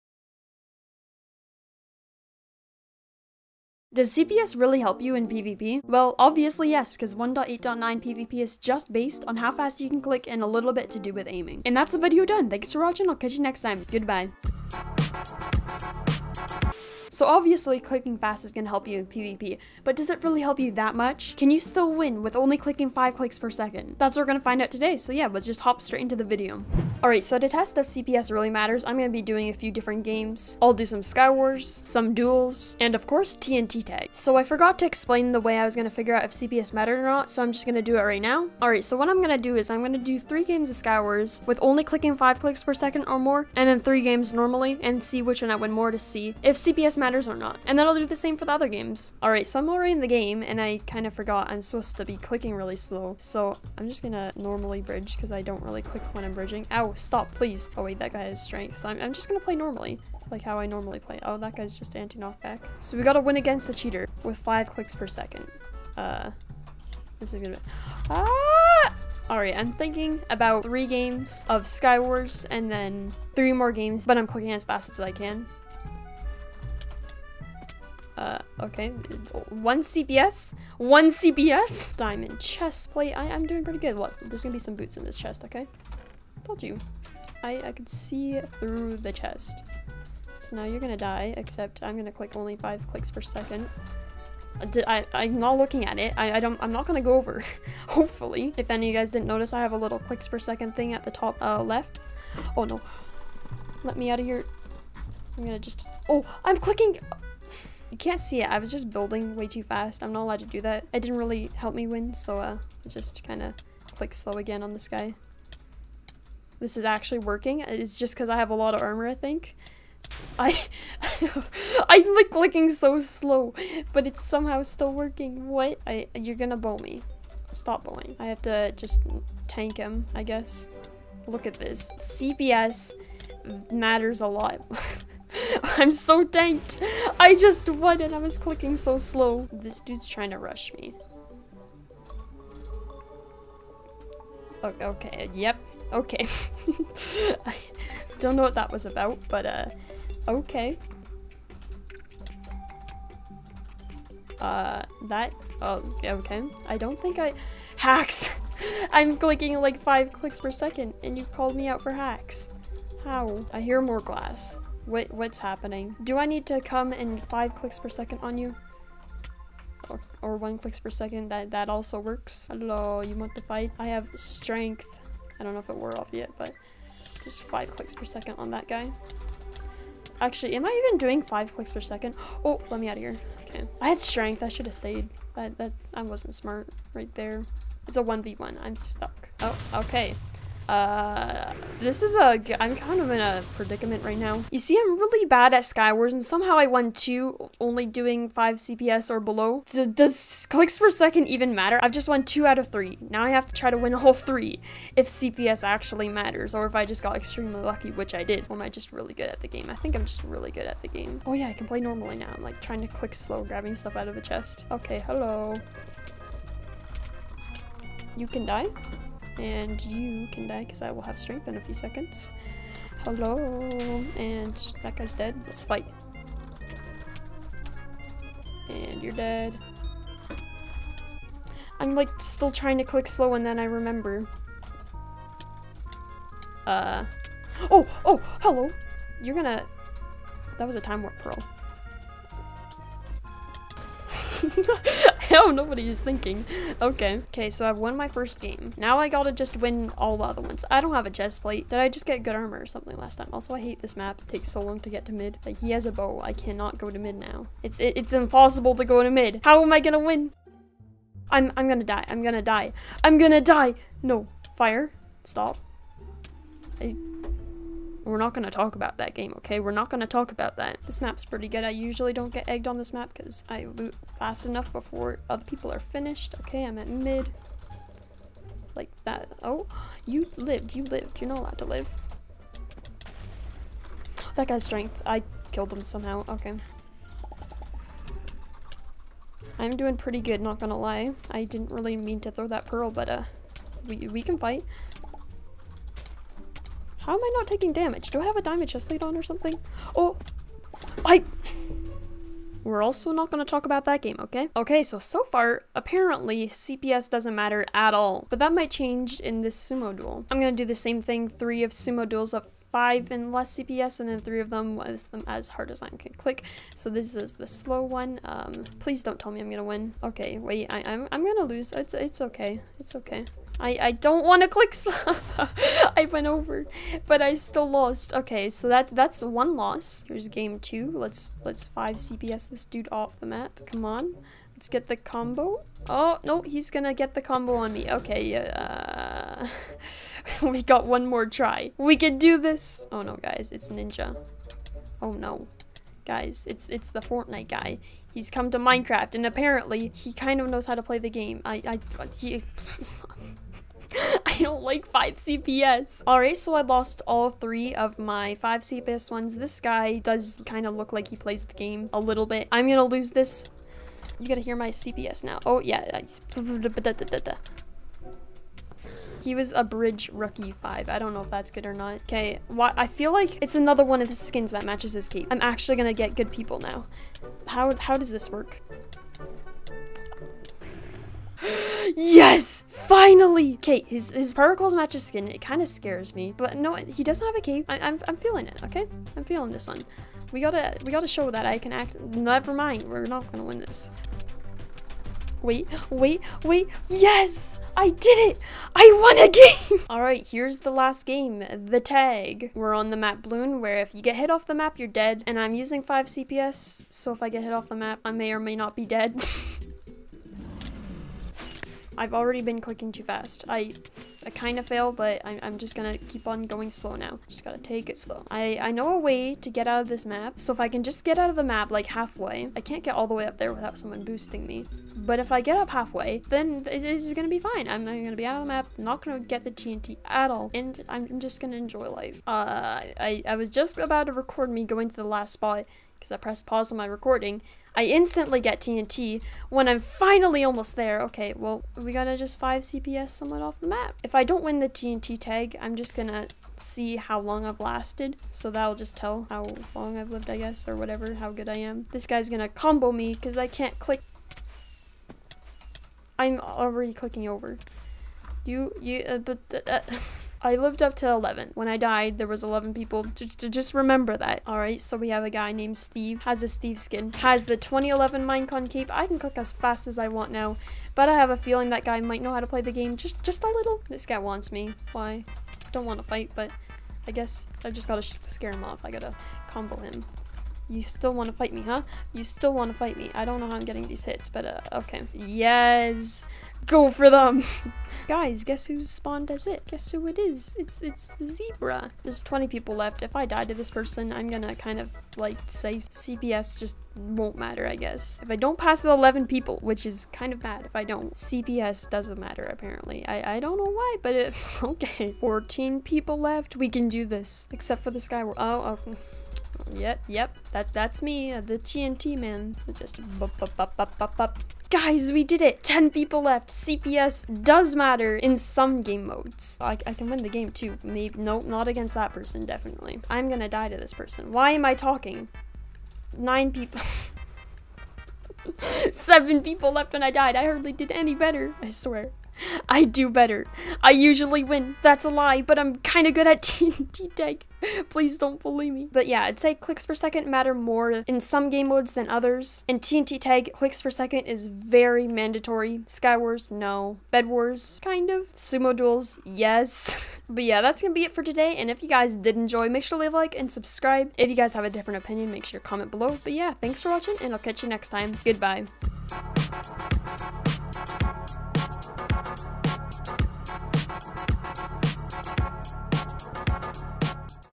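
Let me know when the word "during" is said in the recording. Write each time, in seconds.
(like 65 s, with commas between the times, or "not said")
not said.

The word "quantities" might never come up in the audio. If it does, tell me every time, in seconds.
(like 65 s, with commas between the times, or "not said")
not said.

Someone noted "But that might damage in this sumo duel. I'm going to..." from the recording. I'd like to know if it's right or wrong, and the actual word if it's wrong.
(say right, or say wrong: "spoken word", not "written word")
wrong: "change", not "damage".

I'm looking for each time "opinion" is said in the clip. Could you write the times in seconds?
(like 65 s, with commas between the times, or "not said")
555 s.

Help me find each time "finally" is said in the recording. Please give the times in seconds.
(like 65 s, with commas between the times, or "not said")
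382 s, 439 s.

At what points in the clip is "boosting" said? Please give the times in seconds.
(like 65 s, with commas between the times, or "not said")
424 s.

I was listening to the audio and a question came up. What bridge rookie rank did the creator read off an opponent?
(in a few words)
Bridge rookie five.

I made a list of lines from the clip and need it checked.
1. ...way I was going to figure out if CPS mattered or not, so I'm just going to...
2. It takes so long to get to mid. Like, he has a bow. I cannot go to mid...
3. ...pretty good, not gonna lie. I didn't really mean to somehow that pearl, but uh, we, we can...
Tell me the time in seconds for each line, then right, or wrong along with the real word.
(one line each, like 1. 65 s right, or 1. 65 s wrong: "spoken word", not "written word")
1. 35 s right
2. 254 s right
3. 289 s wrong: "throw", not "somehow".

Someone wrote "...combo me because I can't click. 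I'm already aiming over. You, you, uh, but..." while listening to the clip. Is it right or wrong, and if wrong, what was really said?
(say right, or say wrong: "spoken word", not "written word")
wrong: "clicking", not "aiming".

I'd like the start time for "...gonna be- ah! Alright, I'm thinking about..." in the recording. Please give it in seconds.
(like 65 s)
67 s.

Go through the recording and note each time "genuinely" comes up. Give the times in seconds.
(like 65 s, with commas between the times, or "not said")
not said.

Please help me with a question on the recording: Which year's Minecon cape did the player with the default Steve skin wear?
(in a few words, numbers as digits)
2011.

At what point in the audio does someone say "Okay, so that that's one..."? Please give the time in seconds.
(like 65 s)
328 s.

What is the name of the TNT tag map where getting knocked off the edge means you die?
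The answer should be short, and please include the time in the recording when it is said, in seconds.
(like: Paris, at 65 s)
Balloon, at 403 s.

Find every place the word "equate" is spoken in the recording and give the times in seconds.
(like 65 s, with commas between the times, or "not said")
not said.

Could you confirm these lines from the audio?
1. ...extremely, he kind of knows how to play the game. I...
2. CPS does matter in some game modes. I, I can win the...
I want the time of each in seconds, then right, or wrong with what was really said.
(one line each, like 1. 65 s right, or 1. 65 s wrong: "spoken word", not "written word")
1. 349 s wrong: "apparently", not "extremely"
2. 516 s right.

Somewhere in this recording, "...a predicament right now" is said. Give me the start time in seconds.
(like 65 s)
193 s.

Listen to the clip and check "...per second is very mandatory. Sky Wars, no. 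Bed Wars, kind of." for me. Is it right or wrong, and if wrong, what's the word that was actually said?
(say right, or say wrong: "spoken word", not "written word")
right.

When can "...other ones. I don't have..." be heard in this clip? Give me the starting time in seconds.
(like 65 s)
250 s.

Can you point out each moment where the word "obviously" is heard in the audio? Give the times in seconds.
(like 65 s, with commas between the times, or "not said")
6 s, 17 s.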